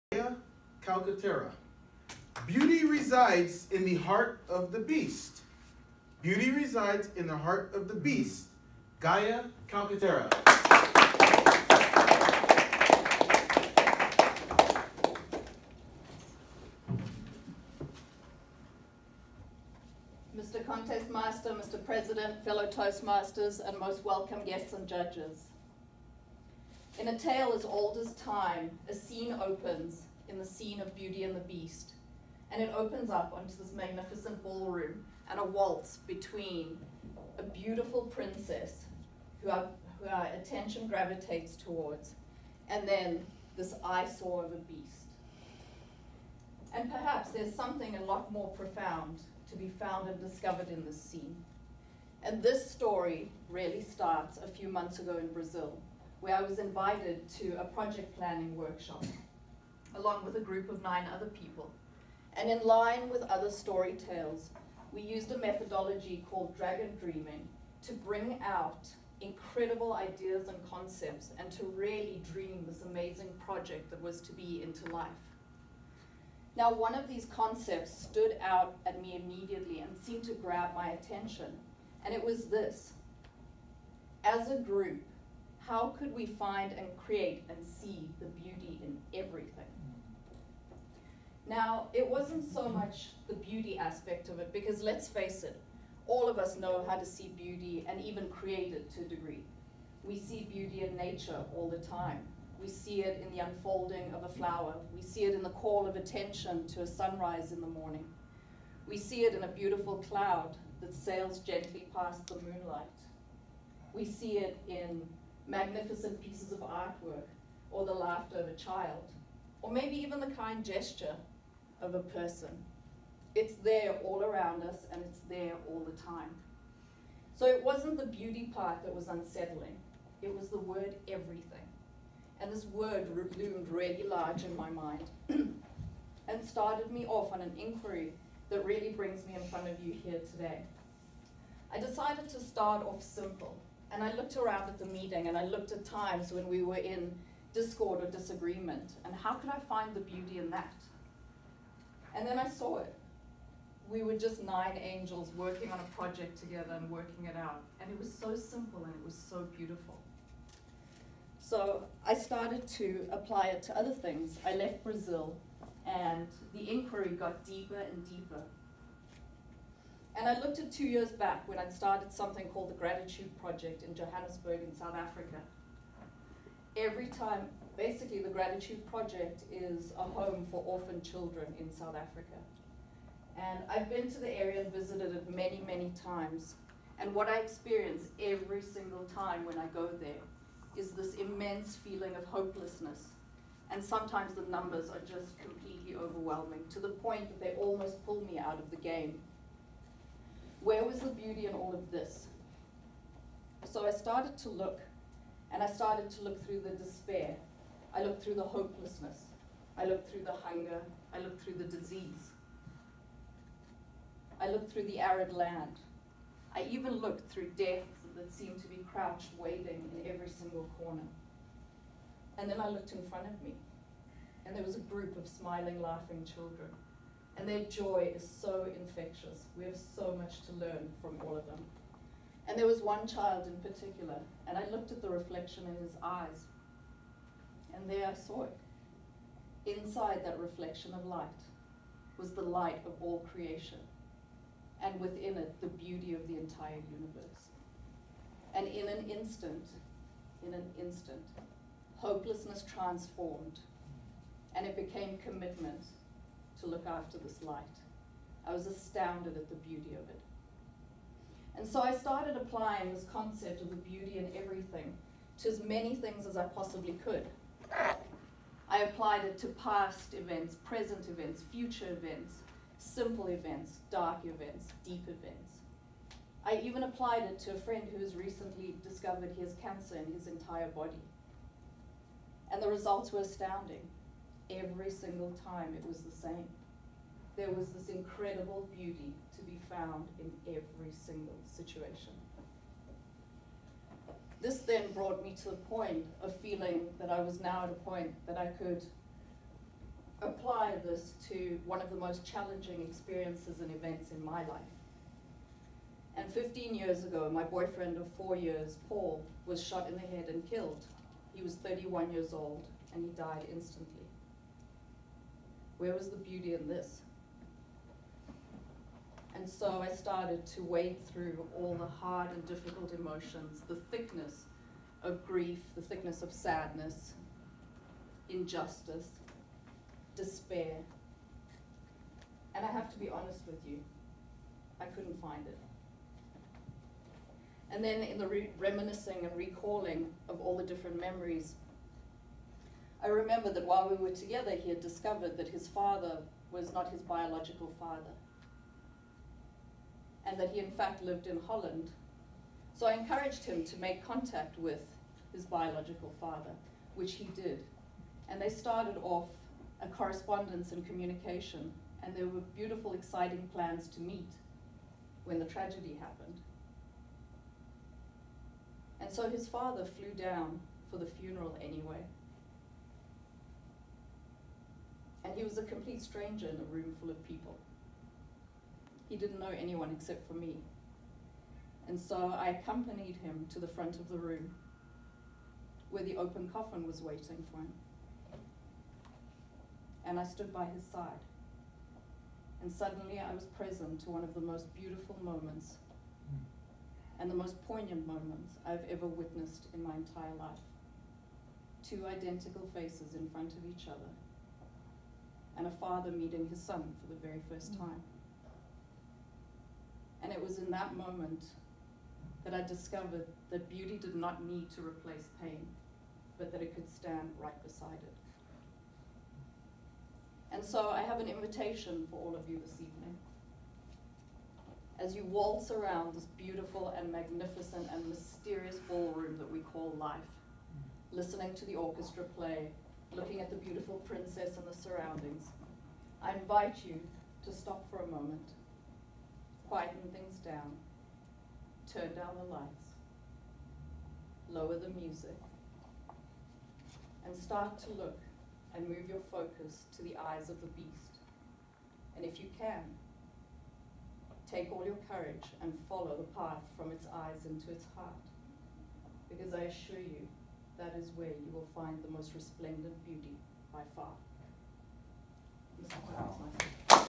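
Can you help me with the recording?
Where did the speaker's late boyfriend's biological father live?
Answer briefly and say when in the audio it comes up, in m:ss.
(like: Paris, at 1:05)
Holland, at 5:51.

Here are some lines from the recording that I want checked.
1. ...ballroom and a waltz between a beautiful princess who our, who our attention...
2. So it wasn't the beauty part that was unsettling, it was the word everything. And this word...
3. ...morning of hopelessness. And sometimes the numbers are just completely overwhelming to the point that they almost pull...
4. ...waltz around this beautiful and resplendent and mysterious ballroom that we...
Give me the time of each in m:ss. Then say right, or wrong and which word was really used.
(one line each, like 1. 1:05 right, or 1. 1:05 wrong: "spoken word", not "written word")
1. 0:34 right
2. 2:07 right
3. 3:11 wrong: "feeling", not "morning"
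4. 7:05 wrong: "magnificent", not "resplendent".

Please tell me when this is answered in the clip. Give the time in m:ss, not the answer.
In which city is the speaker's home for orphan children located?
2:53.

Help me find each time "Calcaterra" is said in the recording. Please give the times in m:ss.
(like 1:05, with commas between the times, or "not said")
0:00, 0:09.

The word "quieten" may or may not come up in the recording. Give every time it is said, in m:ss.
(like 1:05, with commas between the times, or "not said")
7:19.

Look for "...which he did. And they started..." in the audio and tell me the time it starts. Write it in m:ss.
5:56.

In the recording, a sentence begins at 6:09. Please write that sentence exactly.
And so his father flew down for the funeral anyway.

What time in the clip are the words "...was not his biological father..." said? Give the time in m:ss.
5:46.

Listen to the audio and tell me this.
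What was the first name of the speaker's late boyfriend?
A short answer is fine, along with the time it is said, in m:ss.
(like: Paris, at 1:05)
Paul, at 5:08.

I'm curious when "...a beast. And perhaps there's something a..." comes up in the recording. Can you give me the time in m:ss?
0:44.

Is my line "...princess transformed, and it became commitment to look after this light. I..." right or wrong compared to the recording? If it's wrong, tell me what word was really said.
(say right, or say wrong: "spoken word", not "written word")
wrong: "hopelessness", not "princess".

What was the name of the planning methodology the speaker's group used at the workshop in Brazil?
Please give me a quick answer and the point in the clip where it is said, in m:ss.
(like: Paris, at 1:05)
Dragon dreaming, at 1:06.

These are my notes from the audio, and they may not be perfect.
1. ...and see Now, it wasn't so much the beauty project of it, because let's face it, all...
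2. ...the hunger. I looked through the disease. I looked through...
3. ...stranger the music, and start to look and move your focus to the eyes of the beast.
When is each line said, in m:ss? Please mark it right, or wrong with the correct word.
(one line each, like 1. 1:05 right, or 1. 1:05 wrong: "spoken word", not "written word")
1. 1:27 wrong: "aspect", not "project"
2. 3:30 right
3. 7:24 wrong: "lower", not "stranger".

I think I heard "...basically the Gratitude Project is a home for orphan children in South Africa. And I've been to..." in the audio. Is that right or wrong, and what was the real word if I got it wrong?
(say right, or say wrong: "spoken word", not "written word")
right.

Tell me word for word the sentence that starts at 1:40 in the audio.
We see beauty in nature all the time.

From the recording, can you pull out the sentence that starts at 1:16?
Now, one of these concepts stood out at me immediately and seemed to grab my attention, and it was this.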